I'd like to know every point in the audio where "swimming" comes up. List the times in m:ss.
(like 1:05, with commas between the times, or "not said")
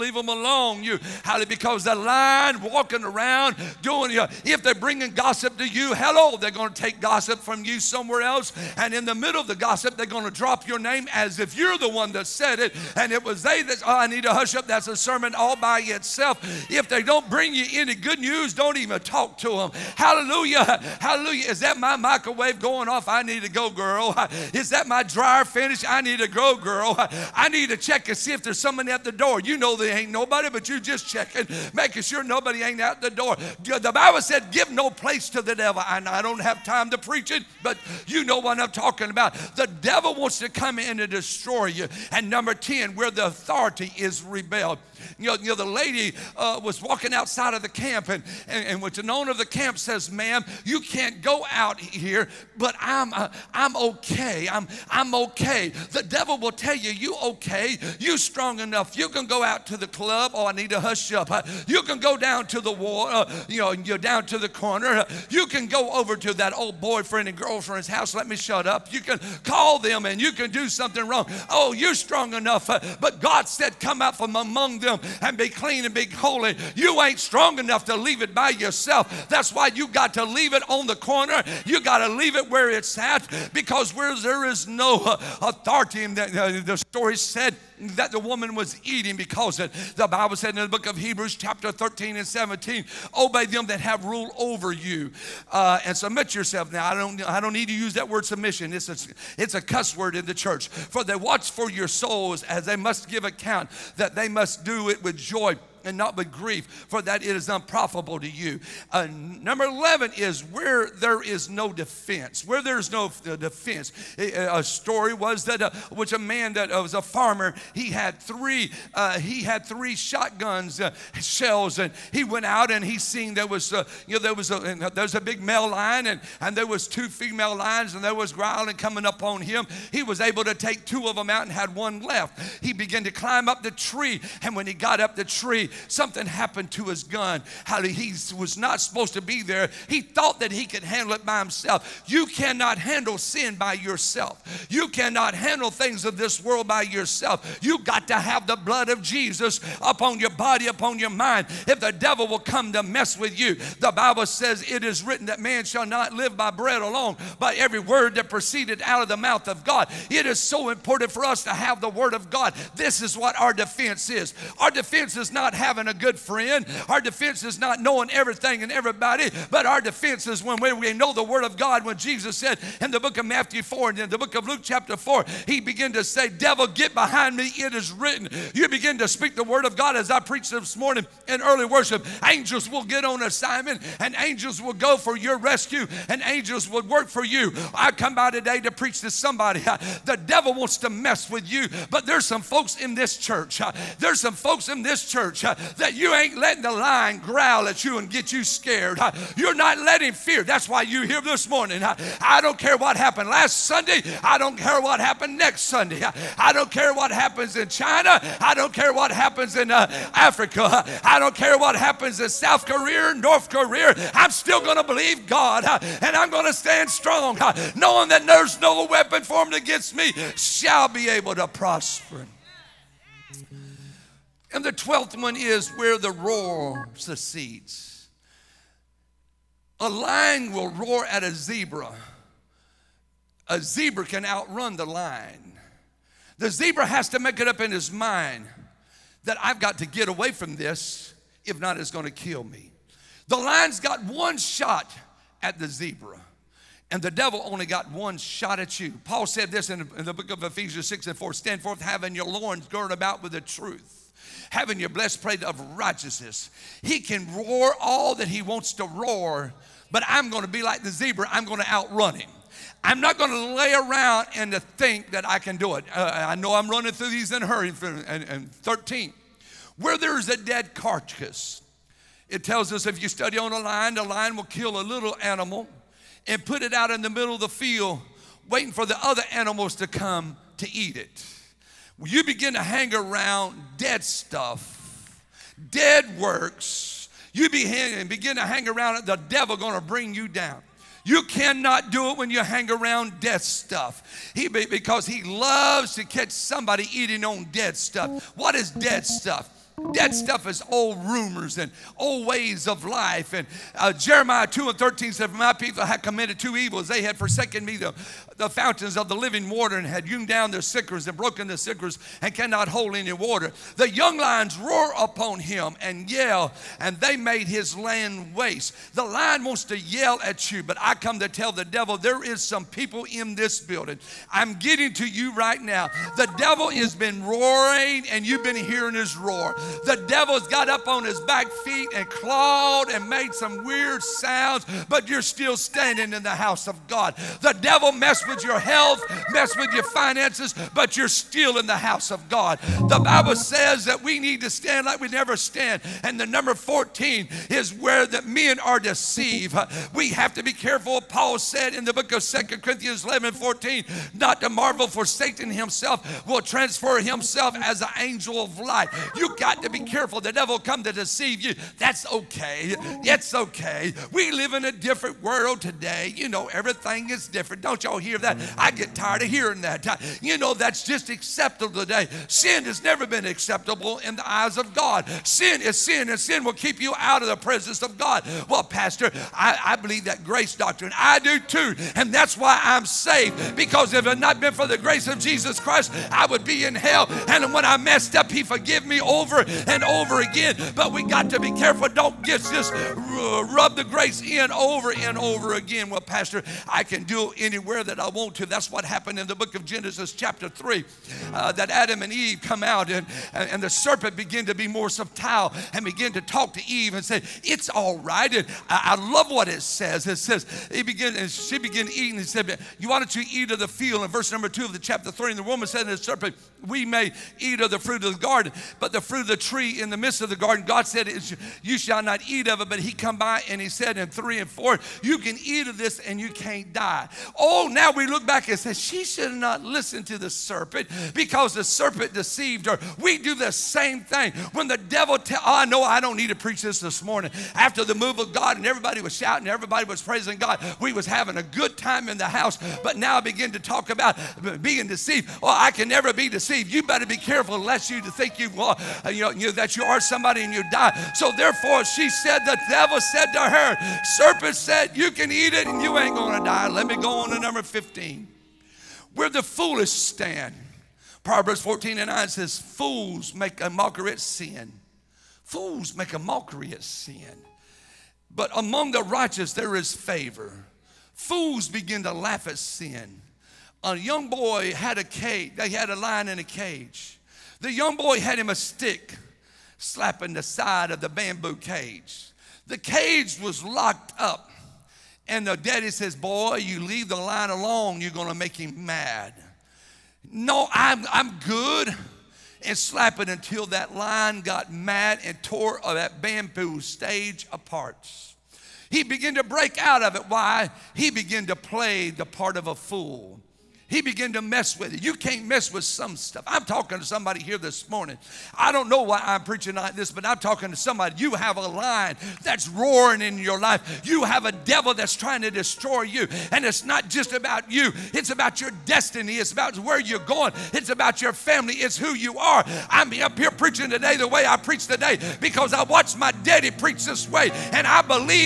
not said.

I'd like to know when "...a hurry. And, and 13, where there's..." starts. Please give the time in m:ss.
4:27.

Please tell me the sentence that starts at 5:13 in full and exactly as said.
The young lions roar upon him and yell, and they made his land waste.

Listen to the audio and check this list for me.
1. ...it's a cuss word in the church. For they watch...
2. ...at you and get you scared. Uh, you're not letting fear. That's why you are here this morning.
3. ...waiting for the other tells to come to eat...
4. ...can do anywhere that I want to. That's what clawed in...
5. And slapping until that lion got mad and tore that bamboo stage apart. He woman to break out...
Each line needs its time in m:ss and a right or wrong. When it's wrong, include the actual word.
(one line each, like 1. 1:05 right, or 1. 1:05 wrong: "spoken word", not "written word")
1. 1:39 right
2. 3:17 right
3. 4:38 wrong: "animals", not "tells"
4. 6:36 wrong: "happened", not "clawed"
5. 8:12 wrong: "began", not "woman".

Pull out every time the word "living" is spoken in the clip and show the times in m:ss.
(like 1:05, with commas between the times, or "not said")
5:09.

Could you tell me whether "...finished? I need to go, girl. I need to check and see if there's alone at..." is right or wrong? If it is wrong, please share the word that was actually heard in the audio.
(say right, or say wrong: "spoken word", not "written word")
wrong: "someone", not "alone".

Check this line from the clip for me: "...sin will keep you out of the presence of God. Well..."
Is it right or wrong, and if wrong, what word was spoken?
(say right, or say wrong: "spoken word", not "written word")
right.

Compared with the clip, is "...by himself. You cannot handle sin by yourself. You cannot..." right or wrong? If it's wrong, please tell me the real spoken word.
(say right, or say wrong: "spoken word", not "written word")
right.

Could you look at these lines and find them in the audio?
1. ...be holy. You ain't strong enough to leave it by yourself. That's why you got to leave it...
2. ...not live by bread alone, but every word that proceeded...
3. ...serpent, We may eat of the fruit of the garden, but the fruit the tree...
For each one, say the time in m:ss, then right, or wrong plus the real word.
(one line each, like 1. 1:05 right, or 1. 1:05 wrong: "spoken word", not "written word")
1. 1:15 right
2. 2:35 right
3. 6:55 right.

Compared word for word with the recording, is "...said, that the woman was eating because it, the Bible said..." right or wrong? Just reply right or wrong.
right.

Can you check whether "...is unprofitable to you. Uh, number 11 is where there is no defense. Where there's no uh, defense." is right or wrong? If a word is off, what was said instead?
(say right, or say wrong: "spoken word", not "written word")
right.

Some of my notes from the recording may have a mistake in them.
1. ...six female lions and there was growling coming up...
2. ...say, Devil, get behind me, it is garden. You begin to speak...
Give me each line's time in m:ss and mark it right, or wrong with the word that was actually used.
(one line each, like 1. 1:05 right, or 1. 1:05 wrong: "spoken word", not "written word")
1. 2:06 wrong: "two", not "six"
2. 2:56 wrong: "written", not "garden".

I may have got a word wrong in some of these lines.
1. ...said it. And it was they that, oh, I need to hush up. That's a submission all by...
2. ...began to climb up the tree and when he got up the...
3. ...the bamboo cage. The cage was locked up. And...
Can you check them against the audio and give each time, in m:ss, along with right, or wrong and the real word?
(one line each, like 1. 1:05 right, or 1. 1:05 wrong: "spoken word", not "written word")
1. 0:12 wrong: "sermon", not "submission"
2. 2:12 right
3. 8:00 right.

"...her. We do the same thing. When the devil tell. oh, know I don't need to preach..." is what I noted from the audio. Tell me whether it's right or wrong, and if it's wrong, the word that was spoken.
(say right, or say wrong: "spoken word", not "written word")
right.